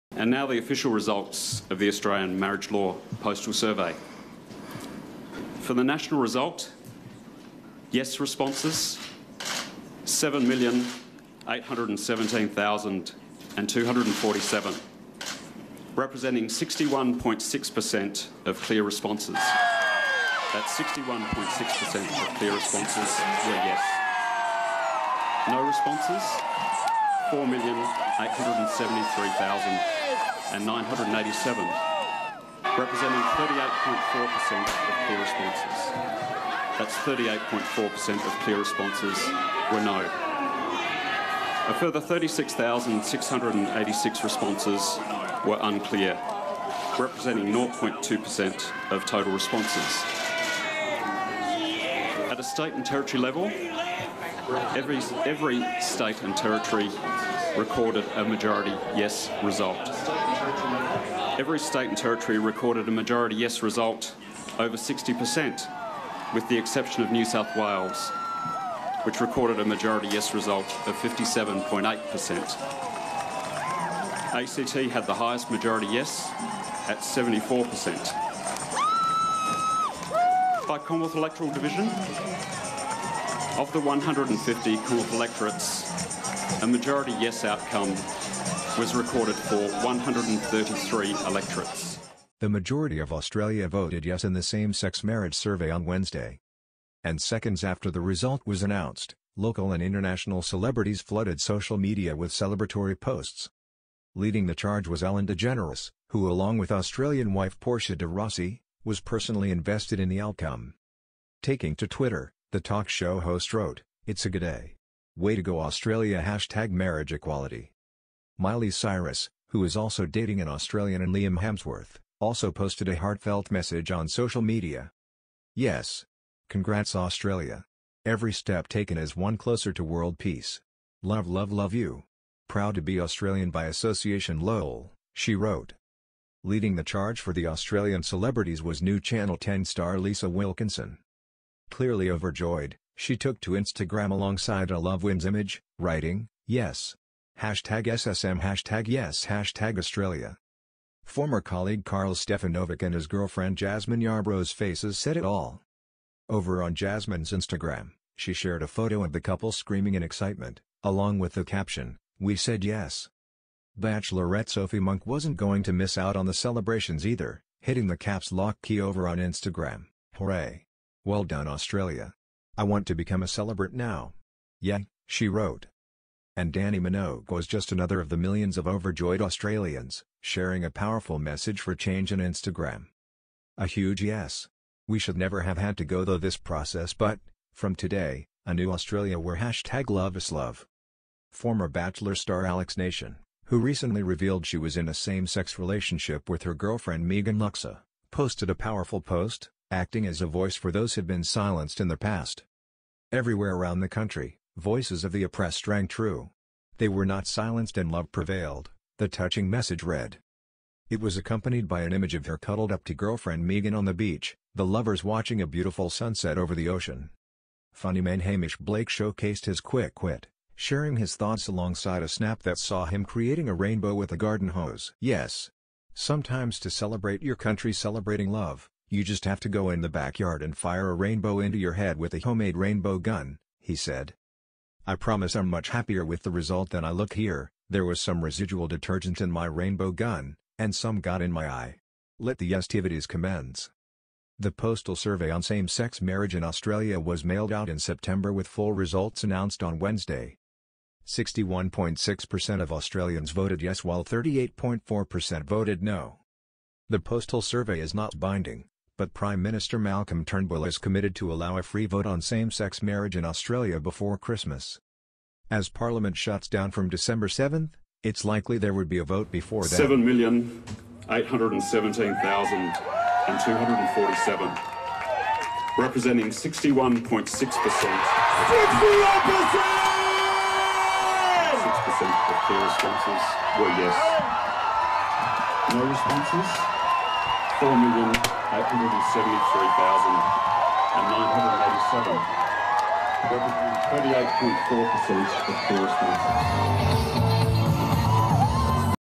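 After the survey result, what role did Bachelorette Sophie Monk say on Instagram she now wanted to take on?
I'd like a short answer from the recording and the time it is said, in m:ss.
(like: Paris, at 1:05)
Celebrant, at 2:53.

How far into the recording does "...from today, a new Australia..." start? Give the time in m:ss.
3:07.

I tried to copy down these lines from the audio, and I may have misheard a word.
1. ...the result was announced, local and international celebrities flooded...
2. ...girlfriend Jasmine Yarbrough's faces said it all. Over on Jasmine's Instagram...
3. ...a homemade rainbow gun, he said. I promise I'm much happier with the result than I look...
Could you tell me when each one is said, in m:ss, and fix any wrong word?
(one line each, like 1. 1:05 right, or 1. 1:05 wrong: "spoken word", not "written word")
1. 1:37 right
2. 2:33 right
3. 3:52 right.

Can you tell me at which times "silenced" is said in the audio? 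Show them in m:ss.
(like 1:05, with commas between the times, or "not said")
3:21, 3:27.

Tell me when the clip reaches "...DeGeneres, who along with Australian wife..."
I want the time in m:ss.
1:45.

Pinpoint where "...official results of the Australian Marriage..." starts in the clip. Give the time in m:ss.
0:00.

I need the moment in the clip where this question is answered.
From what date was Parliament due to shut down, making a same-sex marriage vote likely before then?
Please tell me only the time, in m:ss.
4:26.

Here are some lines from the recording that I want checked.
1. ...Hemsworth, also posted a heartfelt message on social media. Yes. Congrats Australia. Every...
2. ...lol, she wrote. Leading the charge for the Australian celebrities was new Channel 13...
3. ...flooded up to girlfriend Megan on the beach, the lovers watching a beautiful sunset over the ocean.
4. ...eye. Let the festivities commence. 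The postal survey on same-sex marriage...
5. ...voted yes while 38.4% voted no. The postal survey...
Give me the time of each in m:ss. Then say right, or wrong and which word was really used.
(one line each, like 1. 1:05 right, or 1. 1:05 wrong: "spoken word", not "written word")
1. 2:01 right
2. 2:14 wrong: "10", not "13"
3. 3:32 wrong: "cuddled", not "flooded"
4. 4:01 right
5. 4:13 right.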